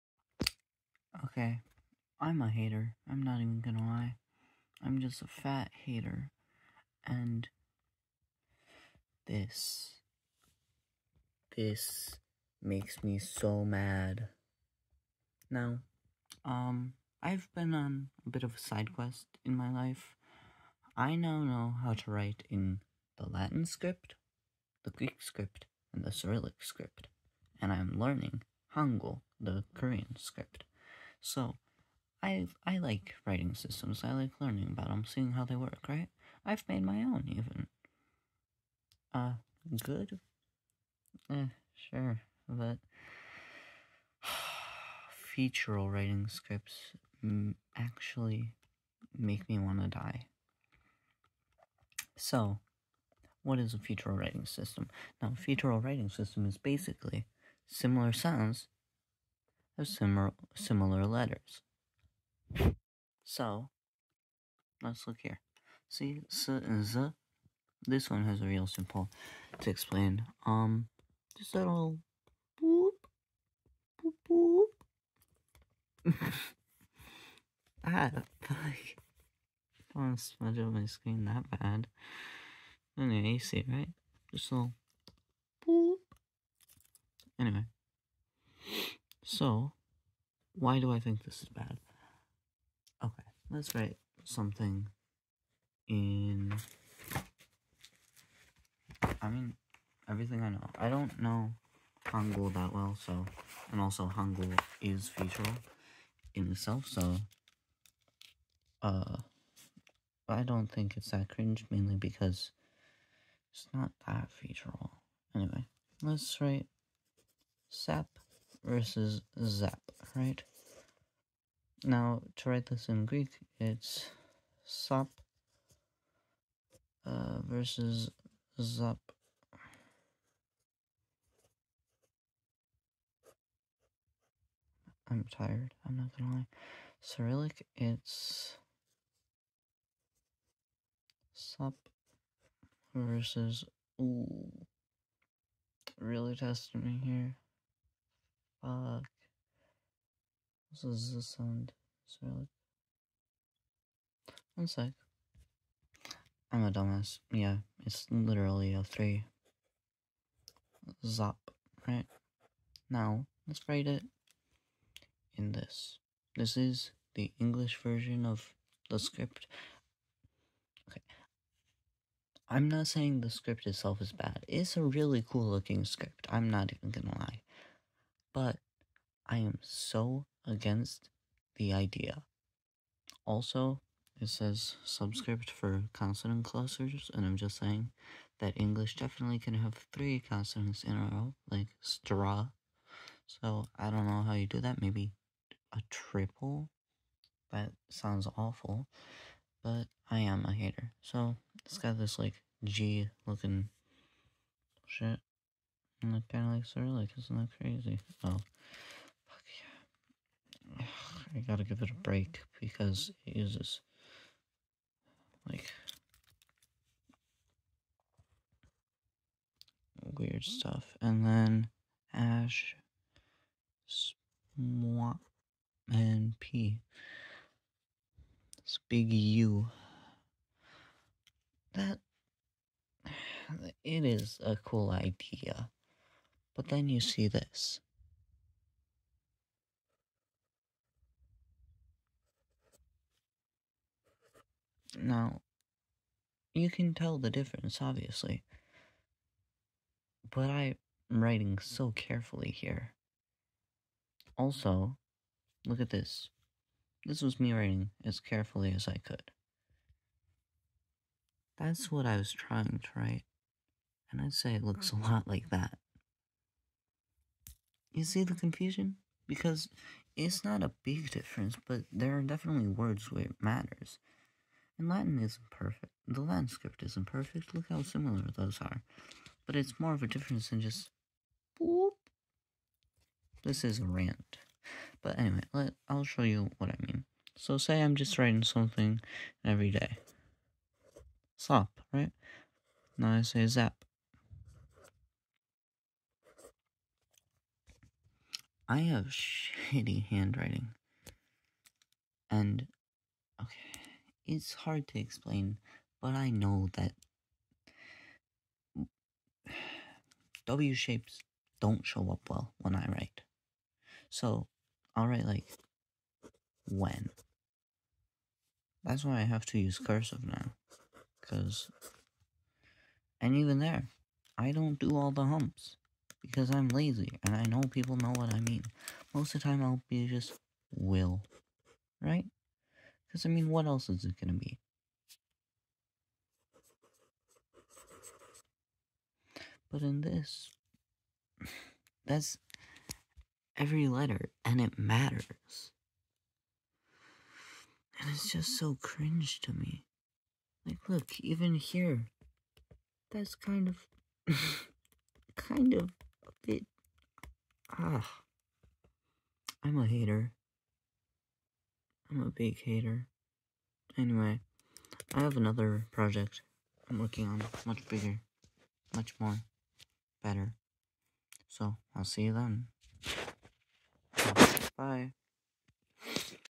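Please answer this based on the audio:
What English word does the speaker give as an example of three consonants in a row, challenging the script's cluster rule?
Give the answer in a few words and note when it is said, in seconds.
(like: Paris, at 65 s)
straw, at 191 s.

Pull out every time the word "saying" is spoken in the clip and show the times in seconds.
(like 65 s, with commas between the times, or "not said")
172 s, 187 s.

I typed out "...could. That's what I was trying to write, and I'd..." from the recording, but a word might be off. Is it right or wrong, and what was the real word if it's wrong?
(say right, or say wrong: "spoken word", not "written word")
right.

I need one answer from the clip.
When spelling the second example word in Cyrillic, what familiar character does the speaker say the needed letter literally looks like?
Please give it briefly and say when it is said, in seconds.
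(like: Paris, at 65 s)
a three, at 158 s.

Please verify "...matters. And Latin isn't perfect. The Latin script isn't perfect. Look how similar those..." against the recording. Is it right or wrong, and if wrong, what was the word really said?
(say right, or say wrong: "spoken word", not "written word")
right.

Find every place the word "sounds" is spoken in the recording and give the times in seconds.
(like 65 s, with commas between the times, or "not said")
58 s, 151 s, 197 s.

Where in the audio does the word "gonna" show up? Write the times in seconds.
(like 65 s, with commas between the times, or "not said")
3 s, 136 s, 176 s, 334 s.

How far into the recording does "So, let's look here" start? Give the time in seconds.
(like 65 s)
63 s.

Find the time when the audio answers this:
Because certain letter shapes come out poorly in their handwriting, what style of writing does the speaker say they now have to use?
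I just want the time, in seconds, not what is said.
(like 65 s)
319 s.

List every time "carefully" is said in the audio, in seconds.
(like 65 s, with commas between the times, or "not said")
251 s, 258 s.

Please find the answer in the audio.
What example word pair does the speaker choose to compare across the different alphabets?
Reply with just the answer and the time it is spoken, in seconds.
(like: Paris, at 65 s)
sap versus zap, at 117 s.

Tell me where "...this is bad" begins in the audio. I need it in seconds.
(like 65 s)
91 s.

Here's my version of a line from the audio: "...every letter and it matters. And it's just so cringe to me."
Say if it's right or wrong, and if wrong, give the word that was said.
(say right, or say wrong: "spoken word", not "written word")
right.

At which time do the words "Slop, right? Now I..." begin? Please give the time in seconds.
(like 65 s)
291 s.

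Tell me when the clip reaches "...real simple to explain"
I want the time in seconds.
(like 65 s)
68 s.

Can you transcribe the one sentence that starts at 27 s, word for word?
And I'm learning Hangul, the Korean script.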